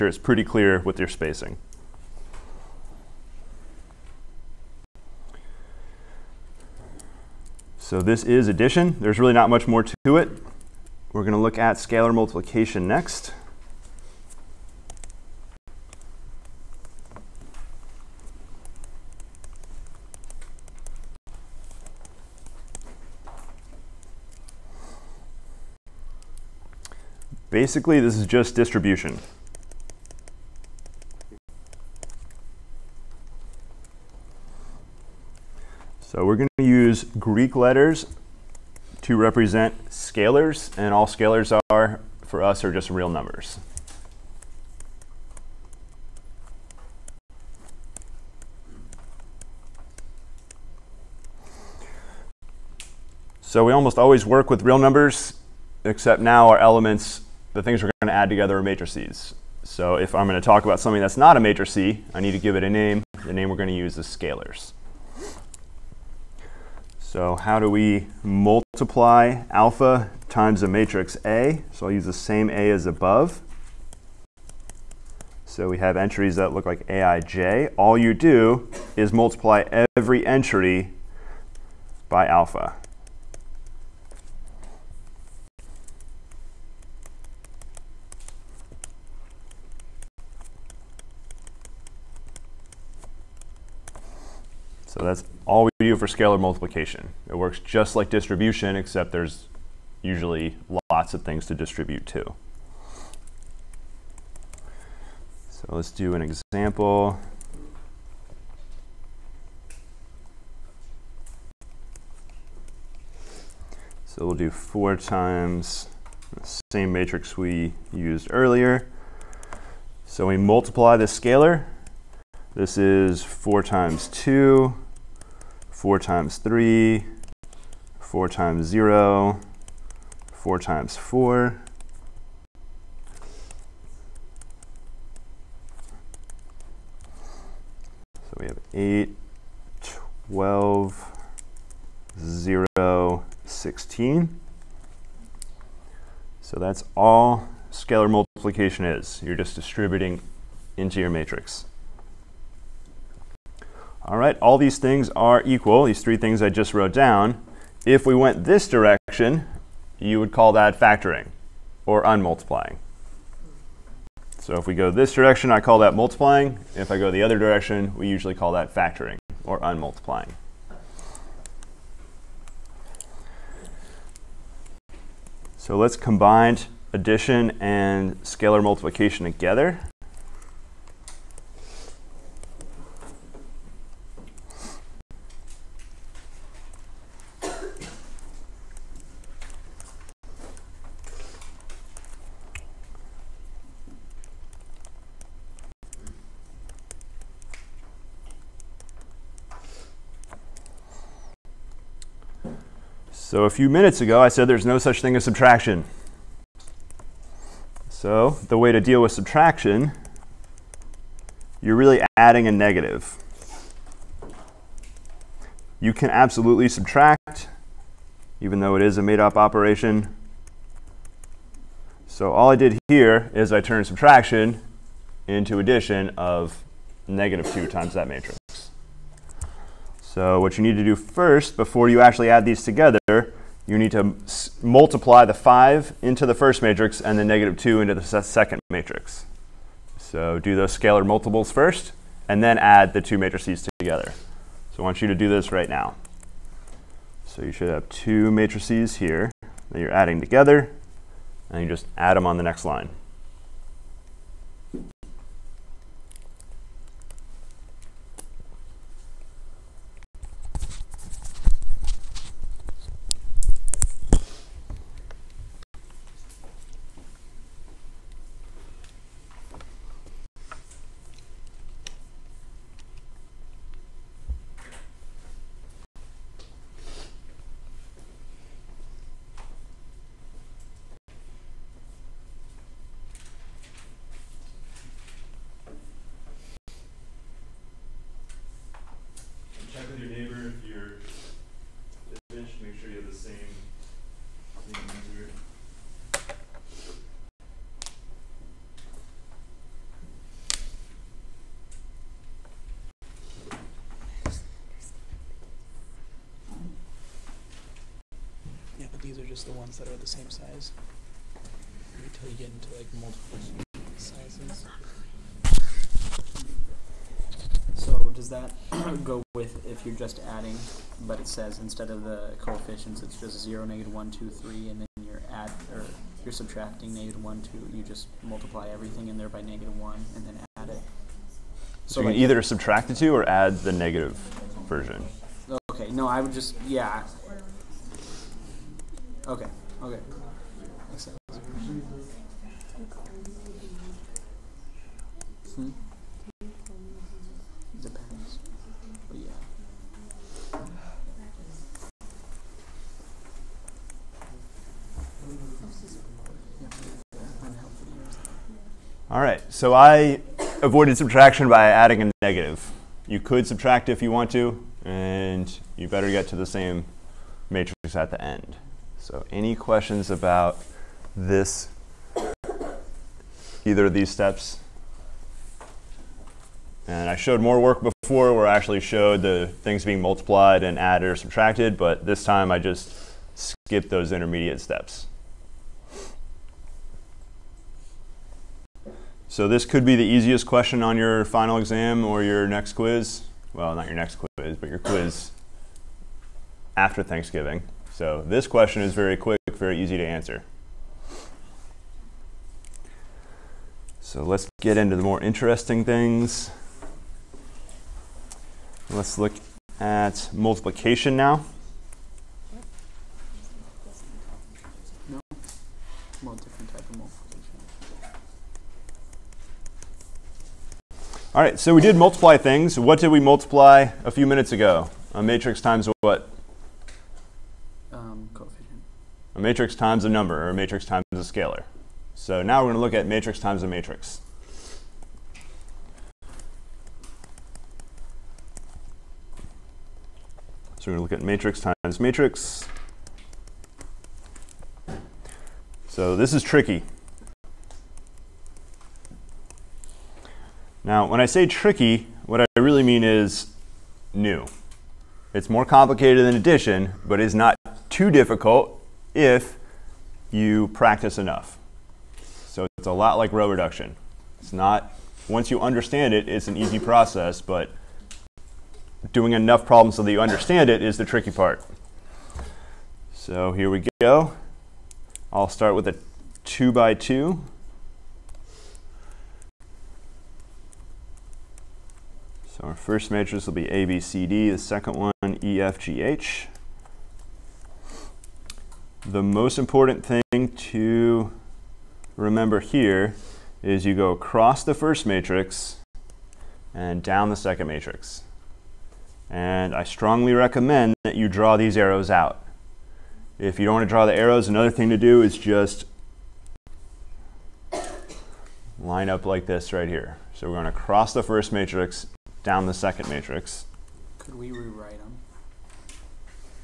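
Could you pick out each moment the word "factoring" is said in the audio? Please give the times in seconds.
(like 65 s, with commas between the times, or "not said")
160 s, 168 s.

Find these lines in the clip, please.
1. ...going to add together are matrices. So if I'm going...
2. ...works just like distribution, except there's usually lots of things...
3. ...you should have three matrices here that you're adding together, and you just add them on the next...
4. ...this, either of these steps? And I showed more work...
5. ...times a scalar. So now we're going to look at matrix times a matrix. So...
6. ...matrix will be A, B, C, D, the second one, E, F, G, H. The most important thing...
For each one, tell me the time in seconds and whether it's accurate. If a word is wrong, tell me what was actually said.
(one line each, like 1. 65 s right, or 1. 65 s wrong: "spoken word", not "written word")
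1. 58 s right
2. 97 s right
3. 247 s wrong: "two", not "three"
4. 371 s right
5. 430 s right
6. 483 s right.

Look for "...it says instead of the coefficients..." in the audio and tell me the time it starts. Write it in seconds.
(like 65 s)
321 s.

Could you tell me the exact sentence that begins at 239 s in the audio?
So do those scalar multiples first, and then add the two matrices together.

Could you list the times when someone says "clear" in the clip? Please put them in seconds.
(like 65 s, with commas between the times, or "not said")
0 s.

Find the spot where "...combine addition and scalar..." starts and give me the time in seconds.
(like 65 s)
175 s.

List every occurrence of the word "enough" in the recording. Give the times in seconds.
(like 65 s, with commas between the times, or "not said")
461 s, 469 s.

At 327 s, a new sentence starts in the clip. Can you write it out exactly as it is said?
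You just multiply everything in there by negative 1 and then add it.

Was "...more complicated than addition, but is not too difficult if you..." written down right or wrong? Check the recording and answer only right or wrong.
right.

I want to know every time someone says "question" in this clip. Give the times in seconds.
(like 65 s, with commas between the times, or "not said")
369 s, 390 s, 398 s.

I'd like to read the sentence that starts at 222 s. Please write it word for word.
So all I did here is I turned subtraction into addition of negative 2 times that matrix.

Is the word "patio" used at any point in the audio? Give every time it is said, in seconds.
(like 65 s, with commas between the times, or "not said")
not said.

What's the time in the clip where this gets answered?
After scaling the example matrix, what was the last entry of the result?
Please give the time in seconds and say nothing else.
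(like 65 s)
143 s.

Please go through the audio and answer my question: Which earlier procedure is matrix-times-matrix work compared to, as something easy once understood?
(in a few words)
row reduction.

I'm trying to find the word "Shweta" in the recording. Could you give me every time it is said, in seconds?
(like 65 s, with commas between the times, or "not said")
not said.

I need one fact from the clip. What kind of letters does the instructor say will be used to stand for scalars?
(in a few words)
Greek letters.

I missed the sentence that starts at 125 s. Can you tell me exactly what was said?
4 times 3, 4 times 0, 4 times 4.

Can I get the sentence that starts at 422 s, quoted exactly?
What did we multiply a few minutes ago?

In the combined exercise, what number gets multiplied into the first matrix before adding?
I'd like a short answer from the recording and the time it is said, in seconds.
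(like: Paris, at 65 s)
5, at 235 s.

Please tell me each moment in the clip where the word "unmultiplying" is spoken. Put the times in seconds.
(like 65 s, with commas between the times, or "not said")
162 s, 169 s.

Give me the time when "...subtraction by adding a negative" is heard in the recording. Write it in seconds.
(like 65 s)
360 s.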